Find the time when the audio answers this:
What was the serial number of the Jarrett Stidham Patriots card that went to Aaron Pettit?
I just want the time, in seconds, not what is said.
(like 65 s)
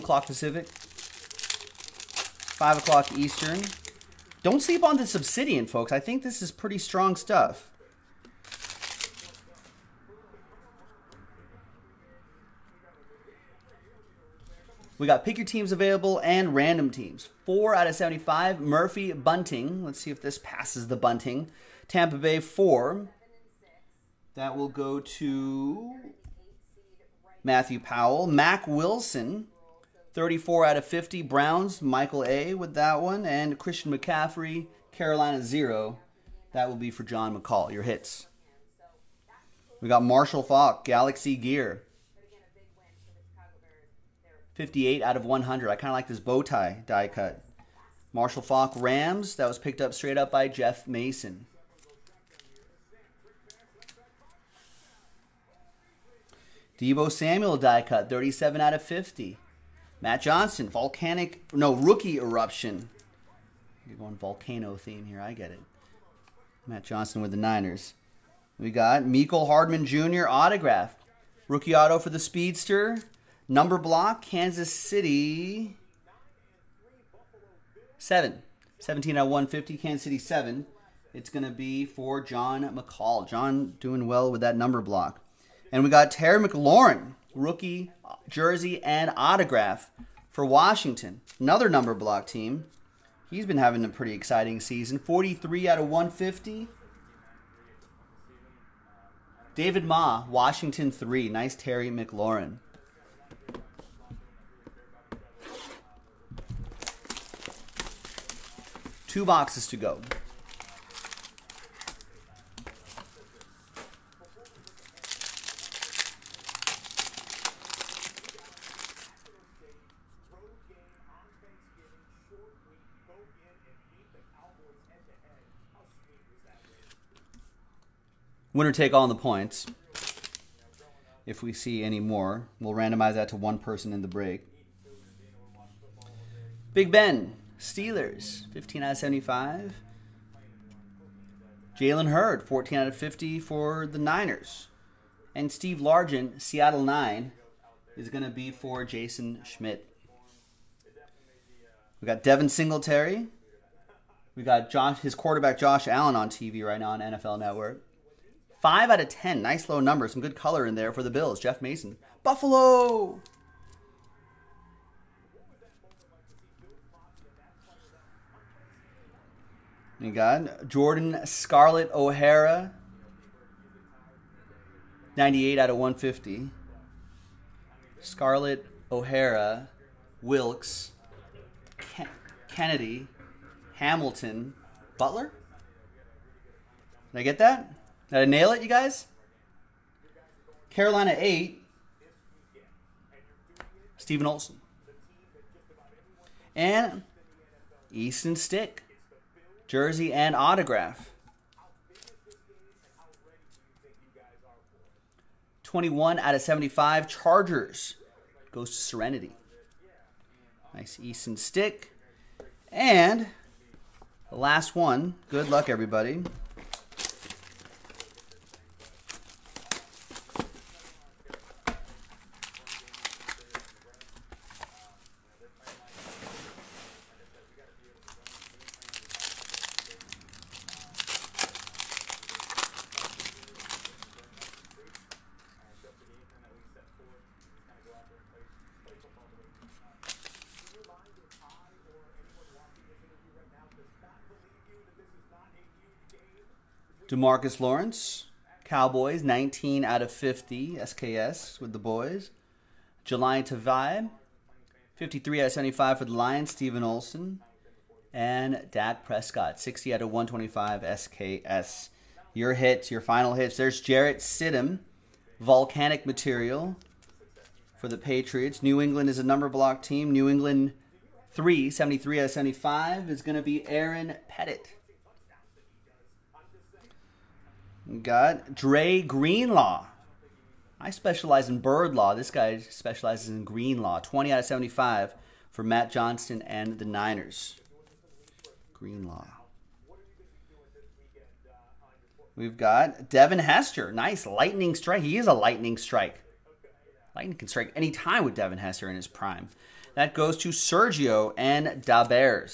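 271 s.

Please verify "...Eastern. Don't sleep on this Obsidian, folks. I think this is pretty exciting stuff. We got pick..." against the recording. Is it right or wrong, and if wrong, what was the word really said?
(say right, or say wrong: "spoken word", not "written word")
wrong: "strong", not "exciting".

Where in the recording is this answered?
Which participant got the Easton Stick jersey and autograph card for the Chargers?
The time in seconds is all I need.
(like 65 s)
208 s.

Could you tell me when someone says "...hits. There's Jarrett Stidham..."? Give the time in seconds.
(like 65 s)
263 s.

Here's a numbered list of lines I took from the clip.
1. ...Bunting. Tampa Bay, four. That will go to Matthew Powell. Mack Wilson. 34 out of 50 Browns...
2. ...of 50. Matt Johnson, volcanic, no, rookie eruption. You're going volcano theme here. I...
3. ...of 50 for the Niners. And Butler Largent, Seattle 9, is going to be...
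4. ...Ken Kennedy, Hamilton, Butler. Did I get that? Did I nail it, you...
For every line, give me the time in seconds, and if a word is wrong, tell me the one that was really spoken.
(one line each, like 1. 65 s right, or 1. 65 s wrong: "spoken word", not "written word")
1. 20 s right
2. 58 s right
3. 142 s wrong: "Steve", not "Butler"
4. 181 s right.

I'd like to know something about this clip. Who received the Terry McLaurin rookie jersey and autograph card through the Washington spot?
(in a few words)
David Ma.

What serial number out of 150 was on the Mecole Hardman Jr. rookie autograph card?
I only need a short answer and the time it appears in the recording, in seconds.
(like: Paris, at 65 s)
17 out of 150, at 78 s.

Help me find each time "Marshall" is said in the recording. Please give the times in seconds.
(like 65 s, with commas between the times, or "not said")
40 s, 48 s.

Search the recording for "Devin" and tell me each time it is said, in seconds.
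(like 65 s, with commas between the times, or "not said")
152 s, 293 s, 298 s.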